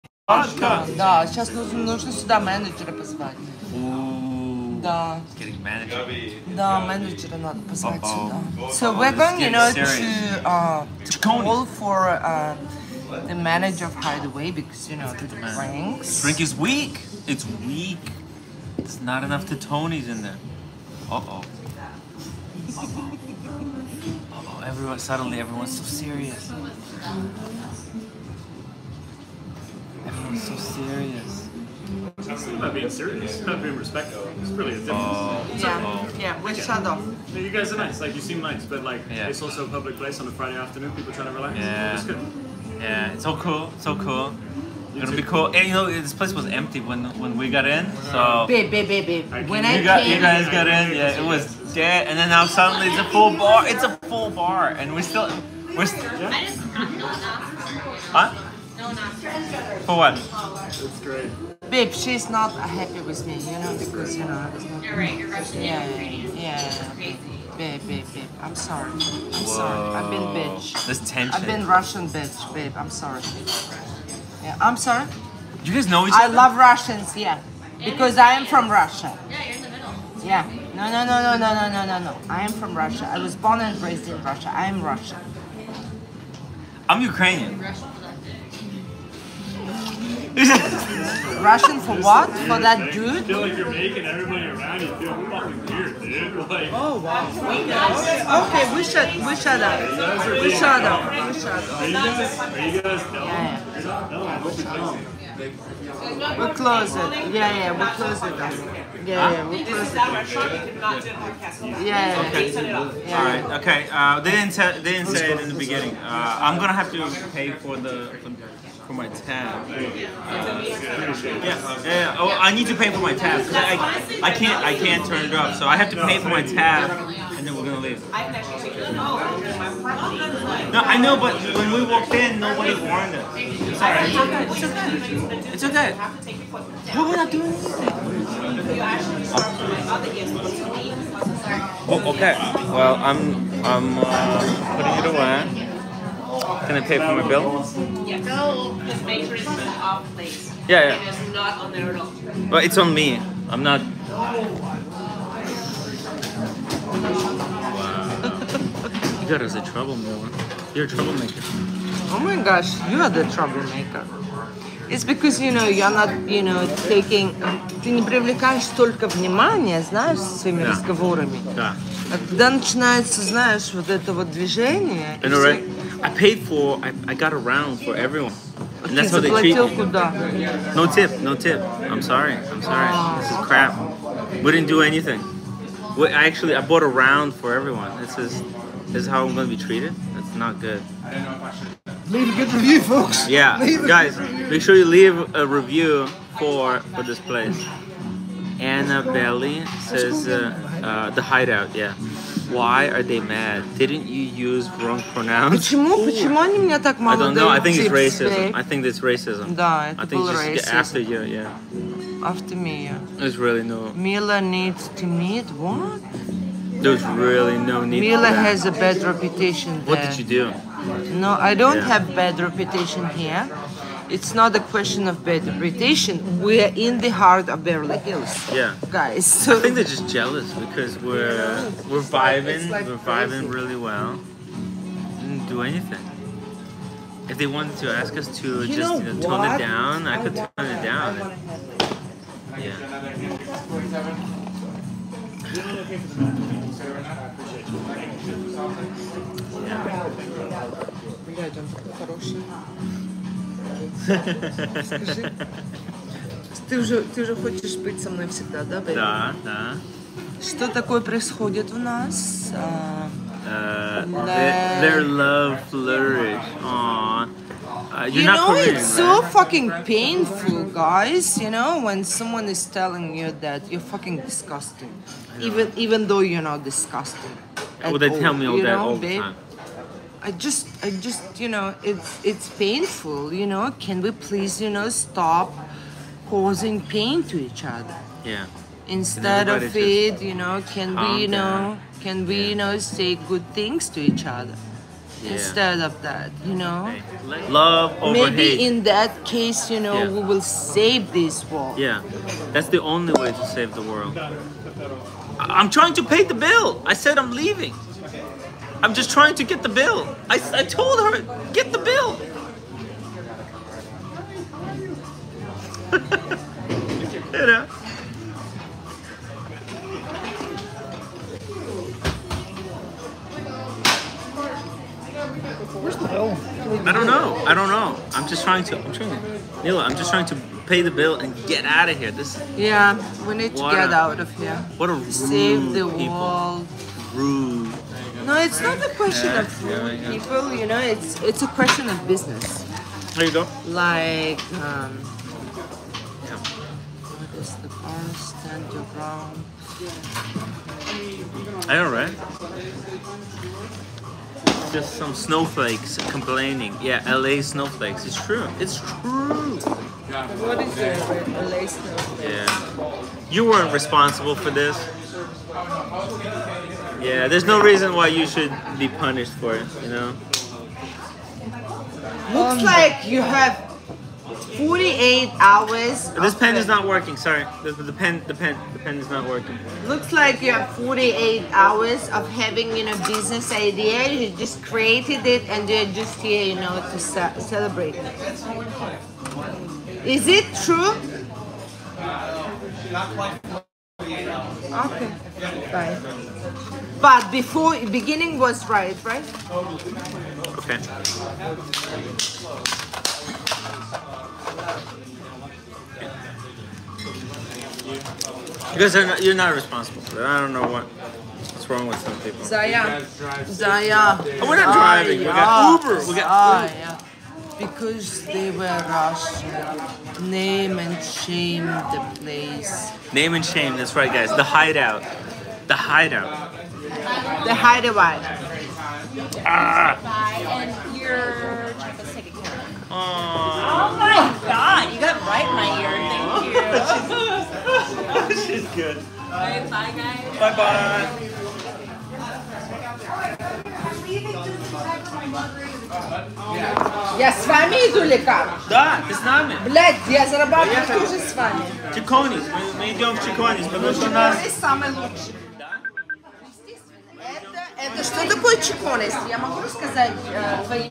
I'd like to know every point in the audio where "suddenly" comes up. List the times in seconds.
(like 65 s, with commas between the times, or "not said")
24 s, 52 s.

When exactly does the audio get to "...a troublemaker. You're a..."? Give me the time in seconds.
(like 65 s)
159 s.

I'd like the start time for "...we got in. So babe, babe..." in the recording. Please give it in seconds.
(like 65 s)
47 s.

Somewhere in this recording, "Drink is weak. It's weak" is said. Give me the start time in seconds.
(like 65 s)
16 s.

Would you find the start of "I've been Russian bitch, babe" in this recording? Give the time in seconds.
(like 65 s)
71 s.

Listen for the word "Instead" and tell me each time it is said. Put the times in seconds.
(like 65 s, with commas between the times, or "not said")
288 s, 295 s.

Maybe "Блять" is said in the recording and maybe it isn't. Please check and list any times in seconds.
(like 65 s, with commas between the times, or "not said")
449 s.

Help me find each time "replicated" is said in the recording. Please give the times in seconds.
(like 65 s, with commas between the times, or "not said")
not said.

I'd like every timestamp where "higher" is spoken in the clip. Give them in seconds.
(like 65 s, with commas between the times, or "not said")
not said.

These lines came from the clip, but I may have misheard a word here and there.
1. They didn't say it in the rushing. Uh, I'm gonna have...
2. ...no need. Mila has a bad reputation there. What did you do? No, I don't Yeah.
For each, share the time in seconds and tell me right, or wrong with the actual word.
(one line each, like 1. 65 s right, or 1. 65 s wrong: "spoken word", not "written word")
1. 114 s wrong: "beginning", not "rushing"
2. 217 s right.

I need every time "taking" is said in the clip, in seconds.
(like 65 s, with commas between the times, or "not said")
166 s.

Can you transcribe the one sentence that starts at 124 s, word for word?
I can't turn it off, so I have to pay for my tab, and then we're gonna leave.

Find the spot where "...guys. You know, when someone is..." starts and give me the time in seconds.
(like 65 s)
270 s.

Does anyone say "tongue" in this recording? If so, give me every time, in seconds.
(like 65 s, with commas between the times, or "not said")
not said.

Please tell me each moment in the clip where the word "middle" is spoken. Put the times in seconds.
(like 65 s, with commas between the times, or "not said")
79 s.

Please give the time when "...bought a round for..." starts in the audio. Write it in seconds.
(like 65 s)
186 s.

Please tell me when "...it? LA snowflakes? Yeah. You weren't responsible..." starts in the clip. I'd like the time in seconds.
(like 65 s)
360 s.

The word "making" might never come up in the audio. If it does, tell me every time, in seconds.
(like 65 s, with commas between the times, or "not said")
93 s.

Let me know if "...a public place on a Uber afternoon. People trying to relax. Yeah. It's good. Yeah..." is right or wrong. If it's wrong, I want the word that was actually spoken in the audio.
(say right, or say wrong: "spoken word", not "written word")
wrong: "Friday", not "Uber".